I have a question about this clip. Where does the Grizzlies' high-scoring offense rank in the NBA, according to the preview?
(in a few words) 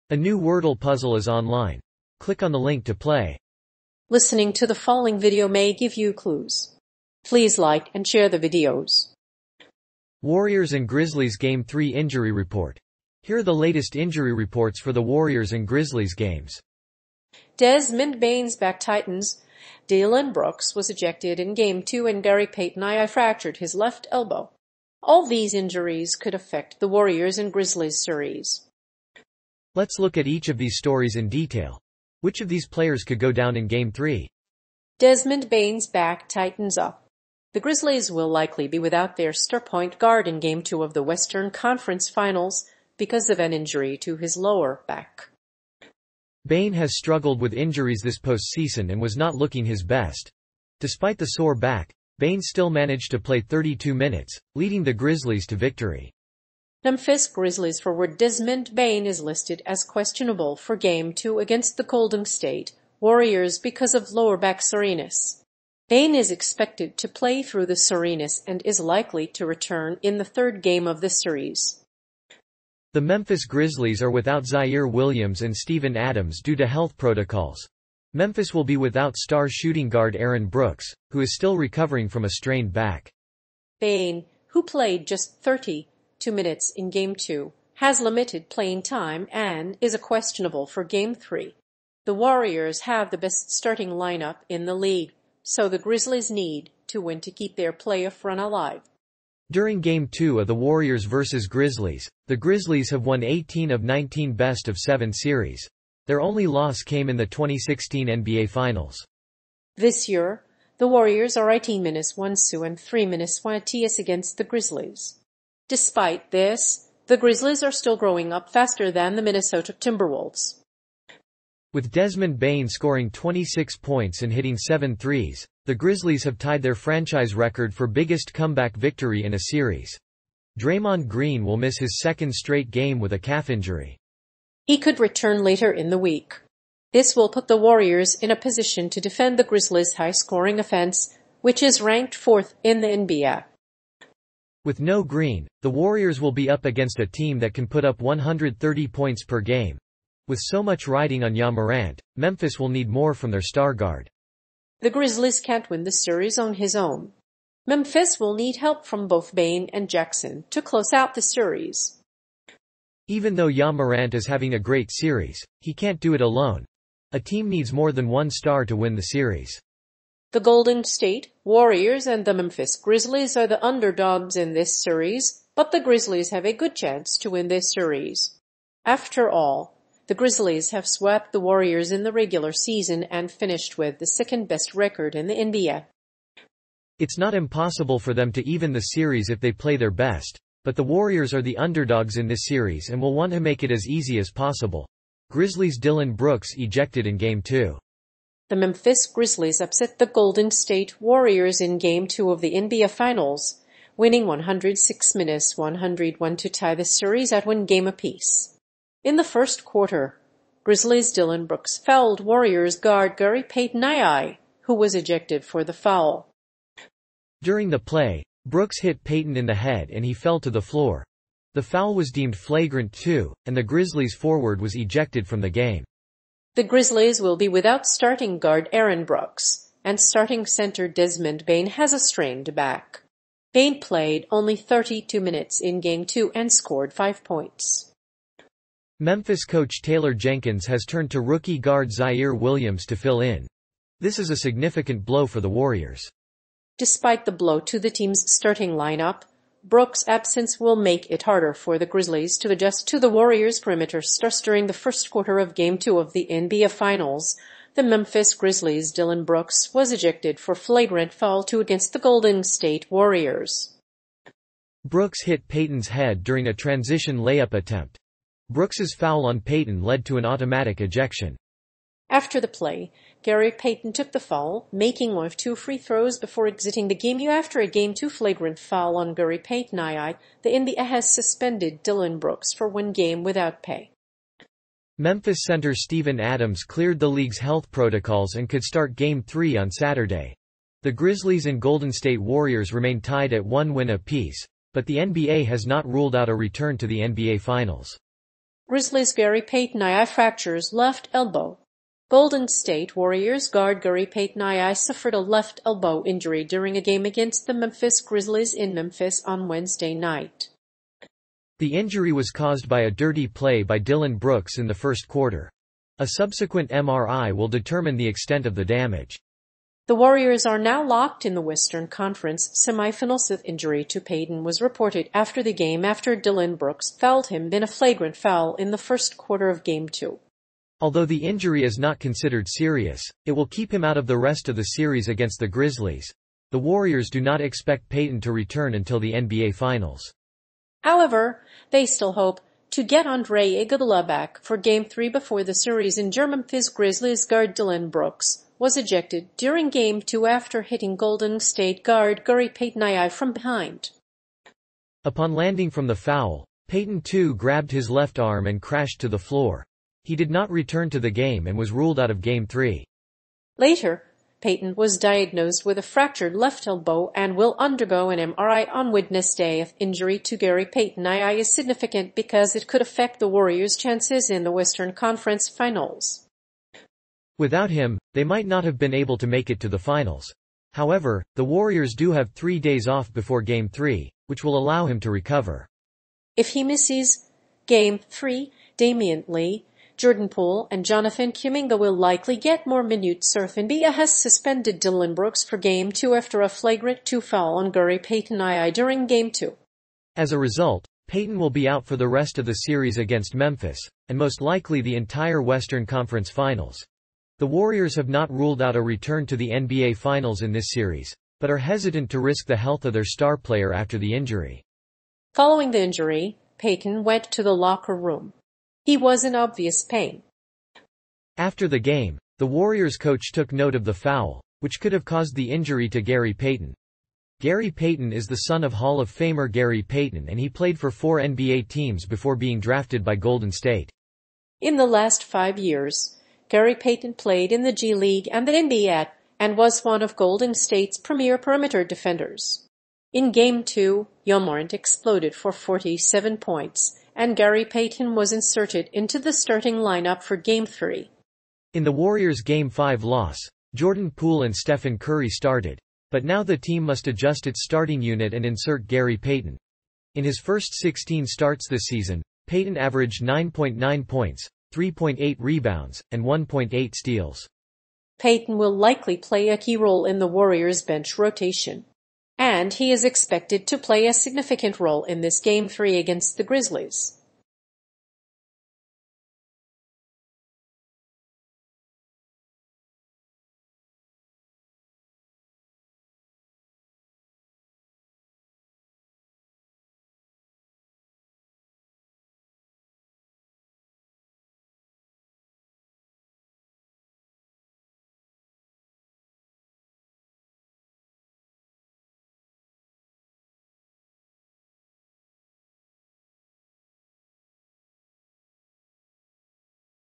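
Fourth.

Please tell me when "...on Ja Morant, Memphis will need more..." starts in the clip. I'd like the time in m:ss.
2:31.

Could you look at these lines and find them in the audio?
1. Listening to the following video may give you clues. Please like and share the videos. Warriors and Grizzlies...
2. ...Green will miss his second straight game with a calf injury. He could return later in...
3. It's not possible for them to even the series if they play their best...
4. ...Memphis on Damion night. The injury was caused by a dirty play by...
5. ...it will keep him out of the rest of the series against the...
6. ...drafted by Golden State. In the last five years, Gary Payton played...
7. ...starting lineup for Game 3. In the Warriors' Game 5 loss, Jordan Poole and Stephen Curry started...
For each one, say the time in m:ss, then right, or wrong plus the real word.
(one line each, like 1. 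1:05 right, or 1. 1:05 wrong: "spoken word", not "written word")
1. 0:04 right
2. 2:11 right
3. 3:06 wrong: "impossible", not "possible"
4. 5:08 wrong: "Wednesday", not "Damion"
5. 5:33 right
6. 7:12 right
7. 7:29 right.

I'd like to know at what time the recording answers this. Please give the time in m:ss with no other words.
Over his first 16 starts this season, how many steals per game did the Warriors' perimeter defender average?
7:46.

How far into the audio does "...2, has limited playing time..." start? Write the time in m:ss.
1:27.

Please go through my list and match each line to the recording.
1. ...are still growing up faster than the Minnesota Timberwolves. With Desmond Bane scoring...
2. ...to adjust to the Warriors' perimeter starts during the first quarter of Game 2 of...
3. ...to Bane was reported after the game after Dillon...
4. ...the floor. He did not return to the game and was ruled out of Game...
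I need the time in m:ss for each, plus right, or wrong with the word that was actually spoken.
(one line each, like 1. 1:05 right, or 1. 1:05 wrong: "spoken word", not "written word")
1. 1:57 right
2. 4:12 right
3. 5:23 wrong: "Payton", not "Bane"
4. 5:59 right.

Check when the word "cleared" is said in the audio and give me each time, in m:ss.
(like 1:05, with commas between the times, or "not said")
4:46.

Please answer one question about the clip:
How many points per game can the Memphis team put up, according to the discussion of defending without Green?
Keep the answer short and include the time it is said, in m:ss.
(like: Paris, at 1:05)
130, at 2:27.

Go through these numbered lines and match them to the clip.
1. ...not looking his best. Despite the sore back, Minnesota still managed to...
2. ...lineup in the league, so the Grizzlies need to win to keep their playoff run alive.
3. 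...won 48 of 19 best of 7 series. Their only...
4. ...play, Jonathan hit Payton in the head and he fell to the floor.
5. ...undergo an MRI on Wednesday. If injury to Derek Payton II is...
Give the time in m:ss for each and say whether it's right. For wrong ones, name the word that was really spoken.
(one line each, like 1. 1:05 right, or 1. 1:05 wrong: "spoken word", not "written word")
1. 0:49 wrong: "Bane", not "Minnesota"
2. 1:33 right
3. 1:43 wrong: "18", not "48"
4. 3:37 wrong: "Brooks", not "Jonathan"
5. 6:07 wrong: "Gary", not "Derek".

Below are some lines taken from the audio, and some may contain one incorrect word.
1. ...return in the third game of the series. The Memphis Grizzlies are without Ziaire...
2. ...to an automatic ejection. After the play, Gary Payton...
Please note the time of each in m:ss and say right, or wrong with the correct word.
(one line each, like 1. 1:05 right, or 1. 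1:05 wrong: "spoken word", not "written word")
1. 1:09 right
2. 4:30 right.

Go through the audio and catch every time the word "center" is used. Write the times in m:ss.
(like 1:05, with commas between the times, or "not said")
3:50, 4:45.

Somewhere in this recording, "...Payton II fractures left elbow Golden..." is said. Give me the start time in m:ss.
4:59.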